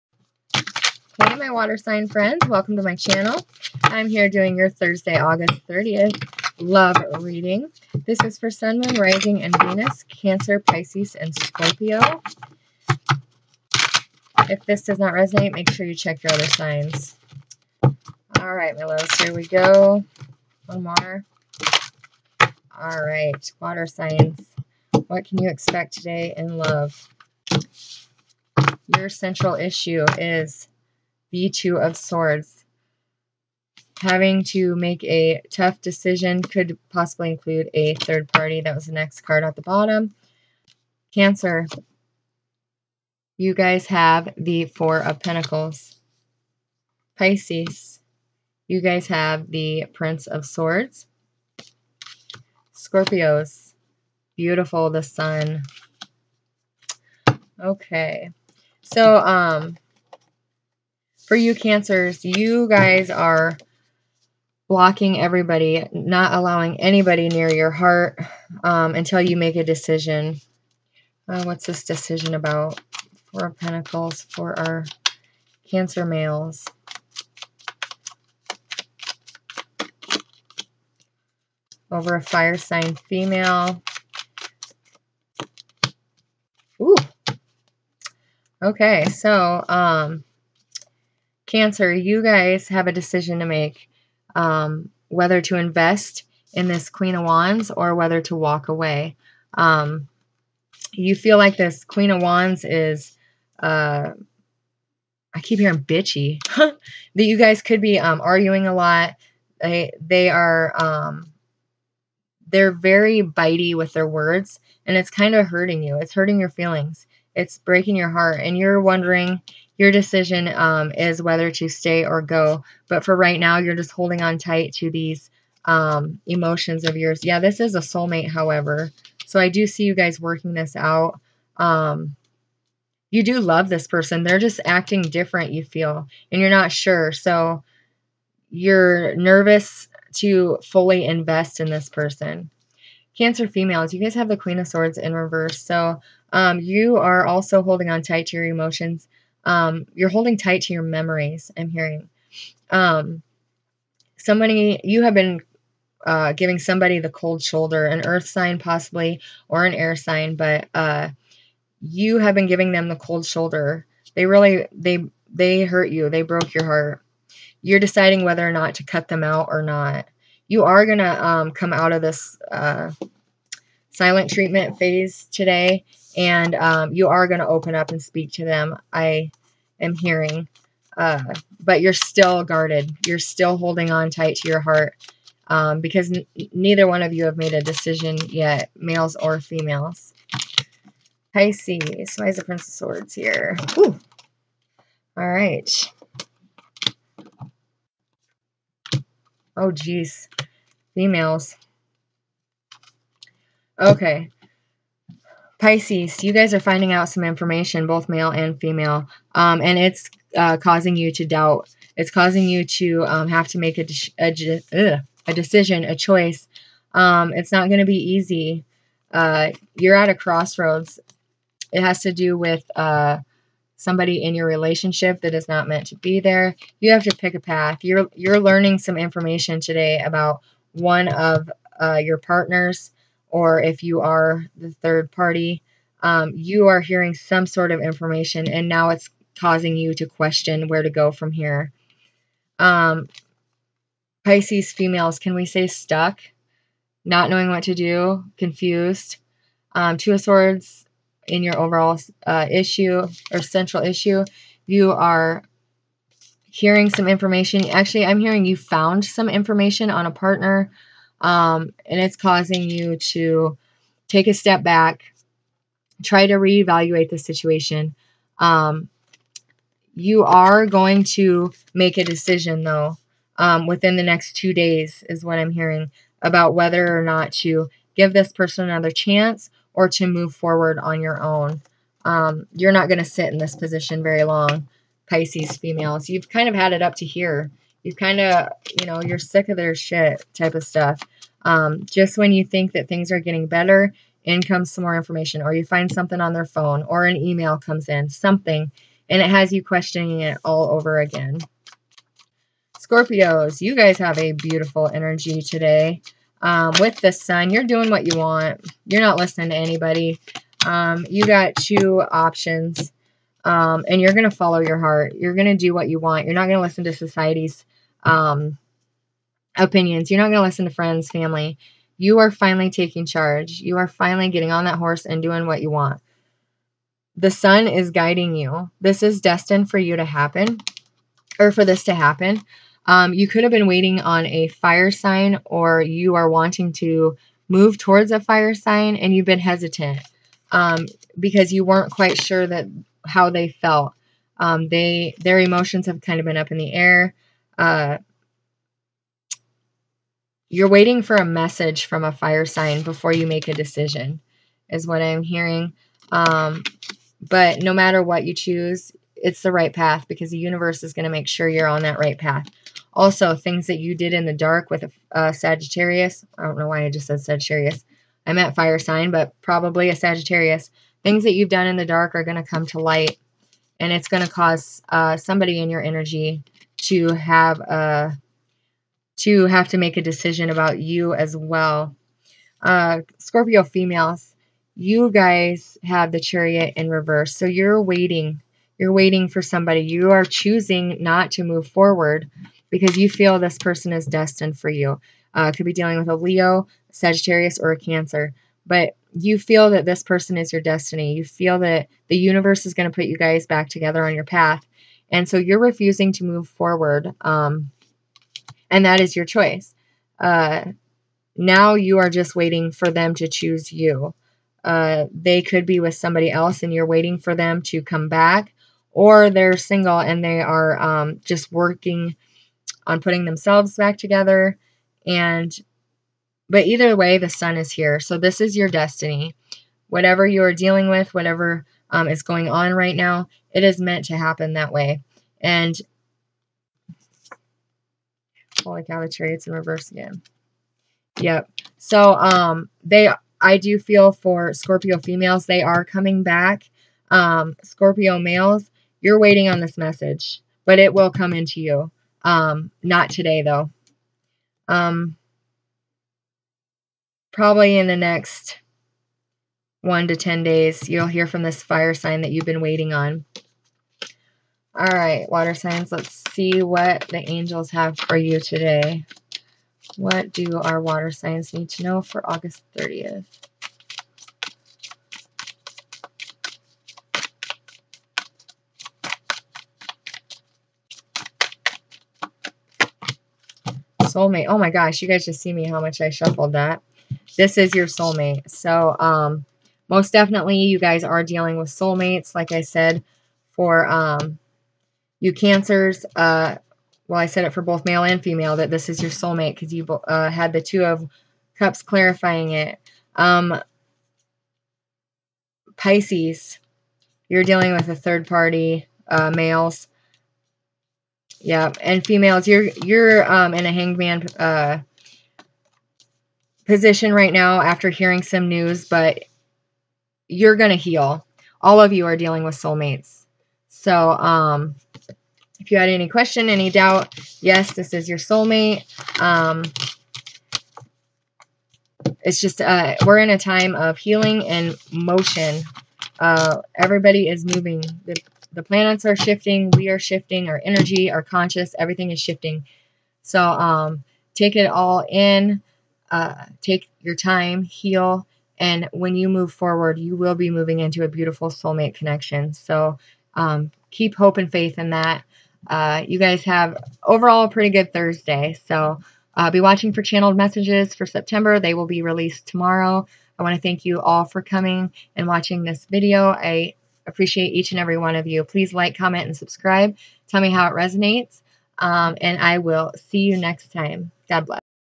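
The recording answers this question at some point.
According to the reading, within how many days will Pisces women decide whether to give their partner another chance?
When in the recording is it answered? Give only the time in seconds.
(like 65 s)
274 s.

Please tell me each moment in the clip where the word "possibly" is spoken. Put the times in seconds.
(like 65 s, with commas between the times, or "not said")
36 s, 158 s.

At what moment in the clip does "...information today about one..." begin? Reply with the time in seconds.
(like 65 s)
228 s.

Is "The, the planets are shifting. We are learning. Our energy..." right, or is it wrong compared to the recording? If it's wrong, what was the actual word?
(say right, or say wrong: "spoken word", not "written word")
wrong: "shifting", not "learning".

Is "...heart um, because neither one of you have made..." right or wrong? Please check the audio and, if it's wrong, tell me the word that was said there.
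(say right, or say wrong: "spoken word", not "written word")
right.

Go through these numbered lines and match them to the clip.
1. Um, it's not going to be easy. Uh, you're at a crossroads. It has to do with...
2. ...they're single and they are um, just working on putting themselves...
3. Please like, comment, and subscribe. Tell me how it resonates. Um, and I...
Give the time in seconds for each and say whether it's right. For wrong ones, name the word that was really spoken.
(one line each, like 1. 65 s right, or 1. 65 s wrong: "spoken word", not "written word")
1. 216 s right
2. 419 s right
3. 568 s right.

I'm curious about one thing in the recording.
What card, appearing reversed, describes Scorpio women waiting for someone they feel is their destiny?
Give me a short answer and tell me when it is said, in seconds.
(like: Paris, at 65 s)
The Chariot, at 386 s.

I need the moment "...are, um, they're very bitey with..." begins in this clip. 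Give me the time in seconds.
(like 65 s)
110 s.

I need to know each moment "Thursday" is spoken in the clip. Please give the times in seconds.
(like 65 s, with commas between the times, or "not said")
4 s, 557 s.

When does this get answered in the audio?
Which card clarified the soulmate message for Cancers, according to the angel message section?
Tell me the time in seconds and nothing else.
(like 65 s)
500 s.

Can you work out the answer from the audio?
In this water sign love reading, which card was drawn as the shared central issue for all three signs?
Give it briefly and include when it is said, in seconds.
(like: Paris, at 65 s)
Two of Swords, at 31 s.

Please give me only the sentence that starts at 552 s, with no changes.
So um, keep hope and faith in that.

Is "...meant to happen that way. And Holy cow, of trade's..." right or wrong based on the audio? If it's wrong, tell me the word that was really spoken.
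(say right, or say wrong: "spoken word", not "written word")
right.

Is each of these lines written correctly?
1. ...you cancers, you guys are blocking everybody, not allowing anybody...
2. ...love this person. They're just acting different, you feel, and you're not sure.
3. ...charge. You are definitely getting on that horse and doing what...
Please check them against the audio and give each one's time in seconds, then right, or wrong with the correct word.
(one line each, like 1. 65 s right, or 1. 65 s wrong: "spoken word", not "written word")
1. 61 s right
2. 133 s right
3. 323 s wrong: "finally", not "definitely".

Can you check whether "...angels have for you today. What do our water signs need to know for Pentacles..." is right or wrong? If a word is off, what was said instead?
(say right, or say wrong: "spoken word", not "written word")
wrong: "August", not "Pentacles".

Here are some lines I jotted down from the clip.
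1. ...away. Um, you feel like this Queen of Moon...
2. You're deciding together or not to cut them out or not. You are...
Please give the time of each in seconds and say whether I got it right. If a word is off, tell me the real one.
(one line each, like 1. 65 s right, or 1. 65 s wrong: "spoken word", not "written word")
1. 98 s wrong: "Wands", not "Moon"
2. 167 s wrong: "whether", not "together".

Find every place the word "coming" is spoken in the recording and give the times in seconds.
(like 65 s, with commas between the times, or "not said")
445 s, 564 s.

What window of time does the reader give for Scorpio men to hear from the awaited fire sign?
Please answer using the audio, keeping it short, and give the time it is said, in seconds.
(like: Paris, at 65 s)
1 to 10 days, at 459 s.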